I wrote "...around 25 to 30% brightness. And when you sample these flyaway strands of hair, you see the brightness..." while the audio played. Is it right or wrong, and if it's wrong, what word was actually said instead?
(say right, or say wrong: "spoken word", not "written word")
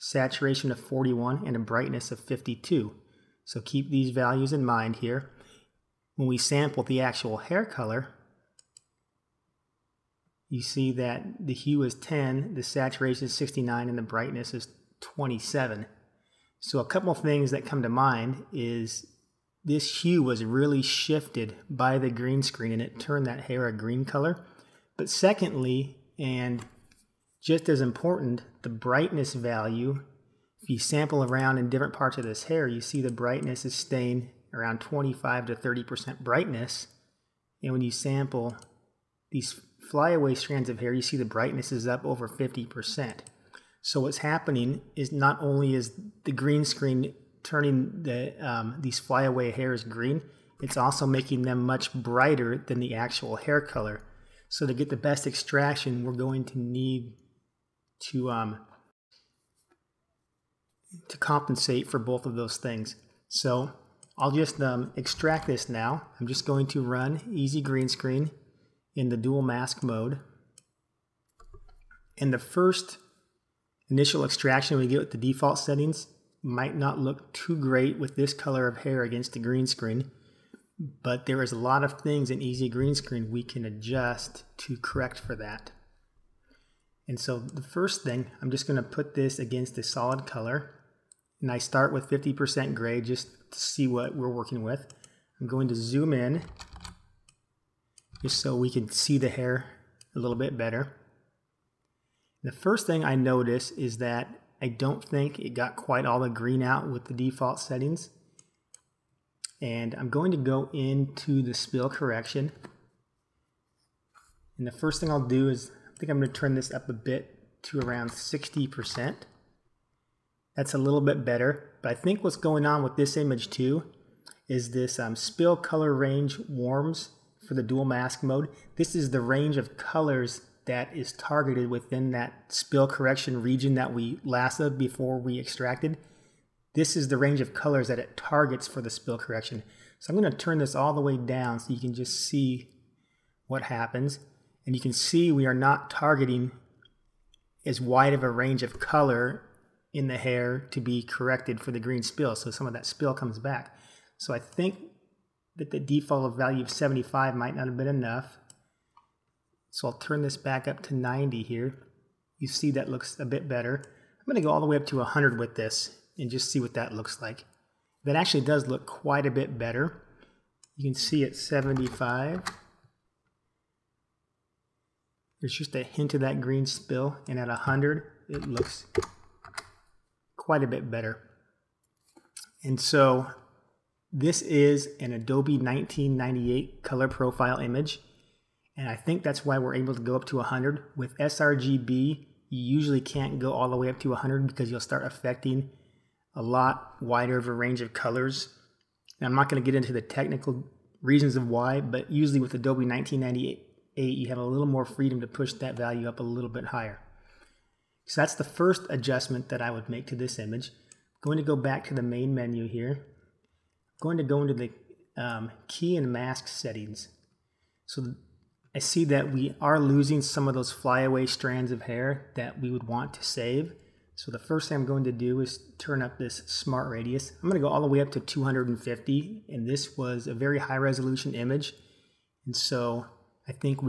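right.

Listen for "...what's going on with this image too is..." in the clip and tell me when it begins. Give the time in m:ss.
2:02.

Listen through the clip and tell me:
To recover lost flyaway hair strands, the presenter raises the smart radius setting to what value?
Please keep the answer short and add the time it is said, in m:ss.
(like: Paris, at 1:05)
250, at 3:48.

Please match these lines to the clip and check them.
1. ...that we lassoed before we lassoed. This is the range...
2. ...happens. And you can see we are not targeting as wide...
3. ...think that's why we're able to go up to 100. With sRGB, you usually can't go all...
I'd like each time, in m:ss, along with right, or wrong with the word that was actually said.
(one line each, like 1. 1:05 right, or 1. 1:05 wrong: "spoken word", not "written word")
1. 2:13 wrong: "extracted", not "lassoed"
2. 2:23 right
3. 3:08 right.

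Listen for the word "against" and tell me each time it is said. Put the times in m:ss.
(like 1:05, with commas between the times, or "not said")
1:19, 1:29.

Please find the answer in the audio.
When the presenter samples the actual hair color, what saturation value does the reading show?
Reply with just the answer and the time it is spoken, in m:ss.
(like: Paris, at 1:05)
69, at 0:12.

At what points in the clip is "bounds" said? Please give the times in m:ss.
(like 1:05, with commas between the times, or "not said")
not said.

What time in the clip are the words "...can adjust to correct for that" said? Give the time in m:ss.
1:23.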